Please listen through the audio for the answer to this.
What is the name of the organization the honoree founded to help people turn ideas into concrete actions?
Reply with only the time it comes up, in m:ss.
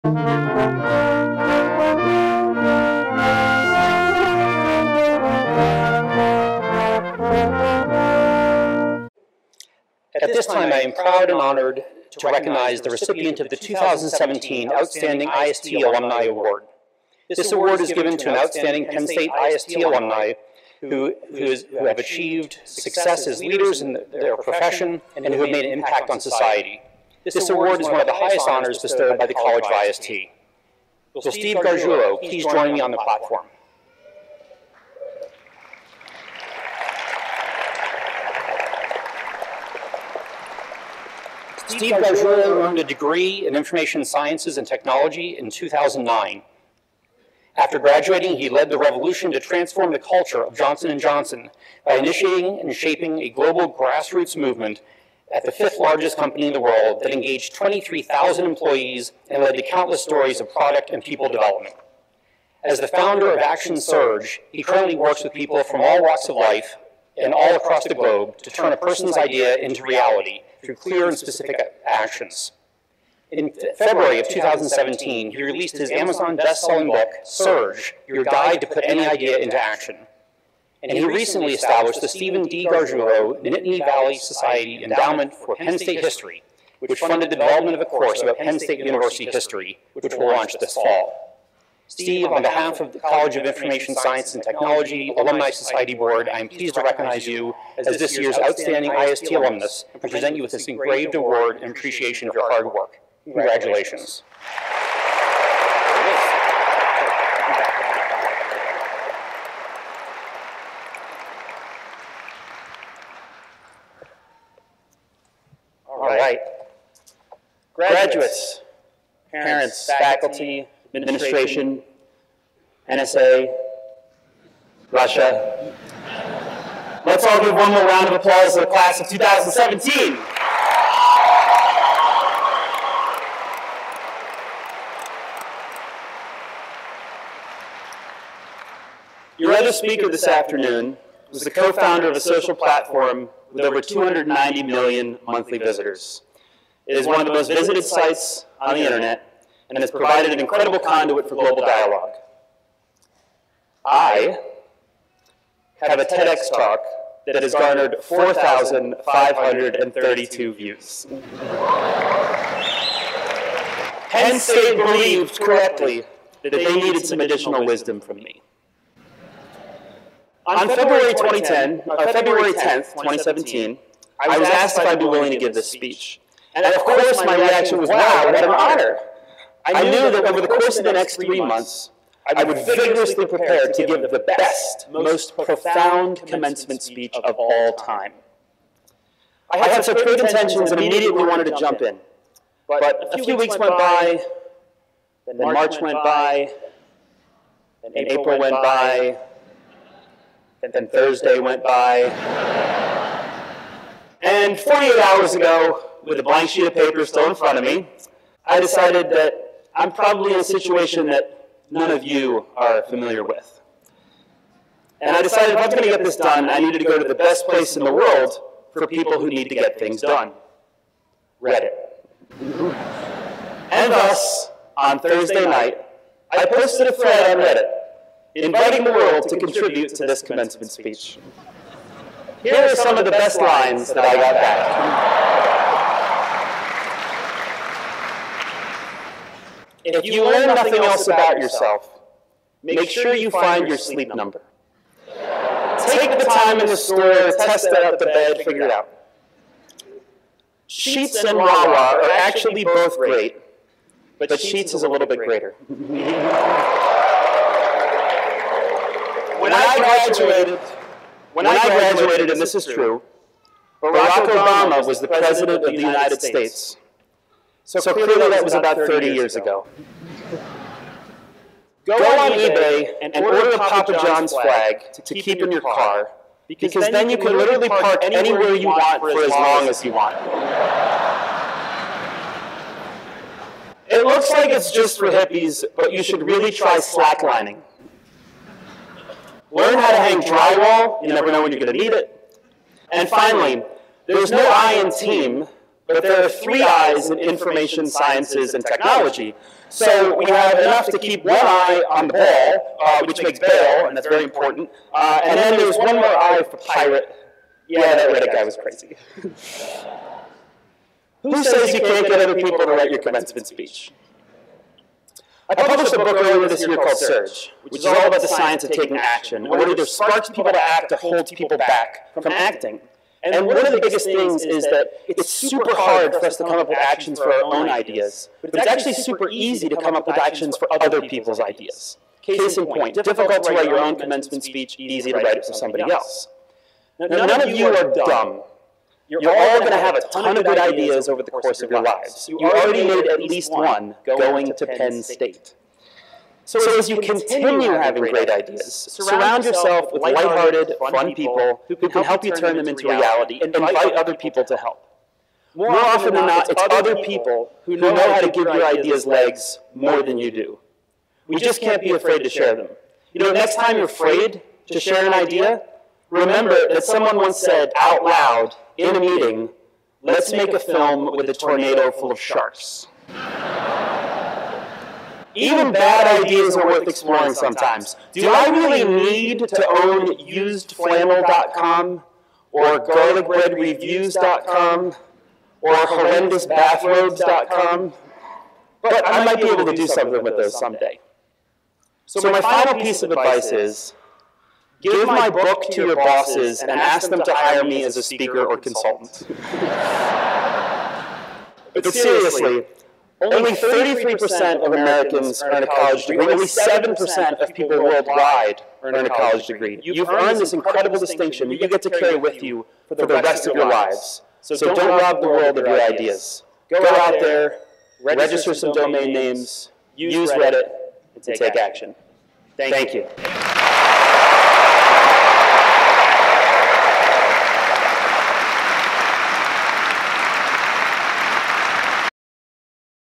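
1:03.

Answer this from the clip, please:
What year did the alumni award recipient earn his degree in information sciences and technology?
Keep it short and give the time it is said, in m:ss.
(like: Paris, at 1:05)
2009, at 0:45.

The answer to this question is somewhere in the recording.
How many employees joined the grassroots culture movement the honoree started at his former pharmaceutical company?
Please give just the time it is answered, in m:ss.
0:57.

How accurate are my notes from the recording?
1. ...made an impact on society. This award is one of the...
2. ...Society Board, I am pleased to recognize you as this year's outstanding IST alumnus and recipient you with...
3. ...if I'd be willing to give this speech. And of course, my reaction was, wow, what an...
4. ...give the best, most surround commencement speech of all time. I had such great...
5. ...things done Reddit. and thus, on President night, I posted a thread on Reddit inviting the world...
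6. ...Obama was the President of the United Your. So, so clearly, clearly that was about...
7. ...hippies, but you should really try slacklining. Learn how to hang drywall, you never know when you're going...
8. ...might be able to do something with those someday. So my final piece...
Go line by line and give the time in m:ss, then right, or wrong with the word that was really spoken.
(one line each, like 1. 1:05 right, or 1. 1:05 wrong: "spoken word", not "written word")
1. 0:25 right
2. 1:35 wrong: "present", not "recipient"
3. 2:54 right
4. 3:03 wrong: "profound", not "surround"
5. 3:39 wrong: "Thursday", not "President"
6. 4:24 wrong: "States", not "Your"
7. 4:45 right
8. 6:29 right.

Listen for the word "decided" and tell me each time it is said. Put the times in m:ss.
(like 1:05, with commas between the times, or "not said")
3:28, 3:35.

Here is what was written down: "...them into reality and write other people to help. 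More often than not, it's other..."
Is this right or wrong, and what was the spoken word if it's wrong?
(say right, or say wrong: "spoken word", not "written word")
wrong: "invite", not "write".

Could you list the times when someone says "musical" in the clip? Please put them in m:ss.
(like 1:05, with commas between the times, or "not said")
not said.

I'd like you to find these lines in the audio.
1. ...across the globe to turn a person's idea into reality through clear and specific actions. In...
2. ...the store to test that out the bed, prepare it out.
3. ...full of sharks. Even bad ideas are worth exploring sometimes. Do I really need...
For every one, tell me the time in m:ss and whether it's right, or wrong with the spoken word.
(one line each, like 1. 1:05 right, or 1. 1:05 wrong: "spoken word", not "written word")
1. 1:07 right
2. 4:06 wrong: "figure", not "prepare"
3. 6:11 right.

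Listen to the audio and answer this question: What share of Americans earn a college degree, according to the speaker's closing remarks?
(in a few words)
33%.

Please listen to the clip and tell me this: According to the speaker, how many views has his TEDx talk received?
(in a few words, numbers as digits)
4,532.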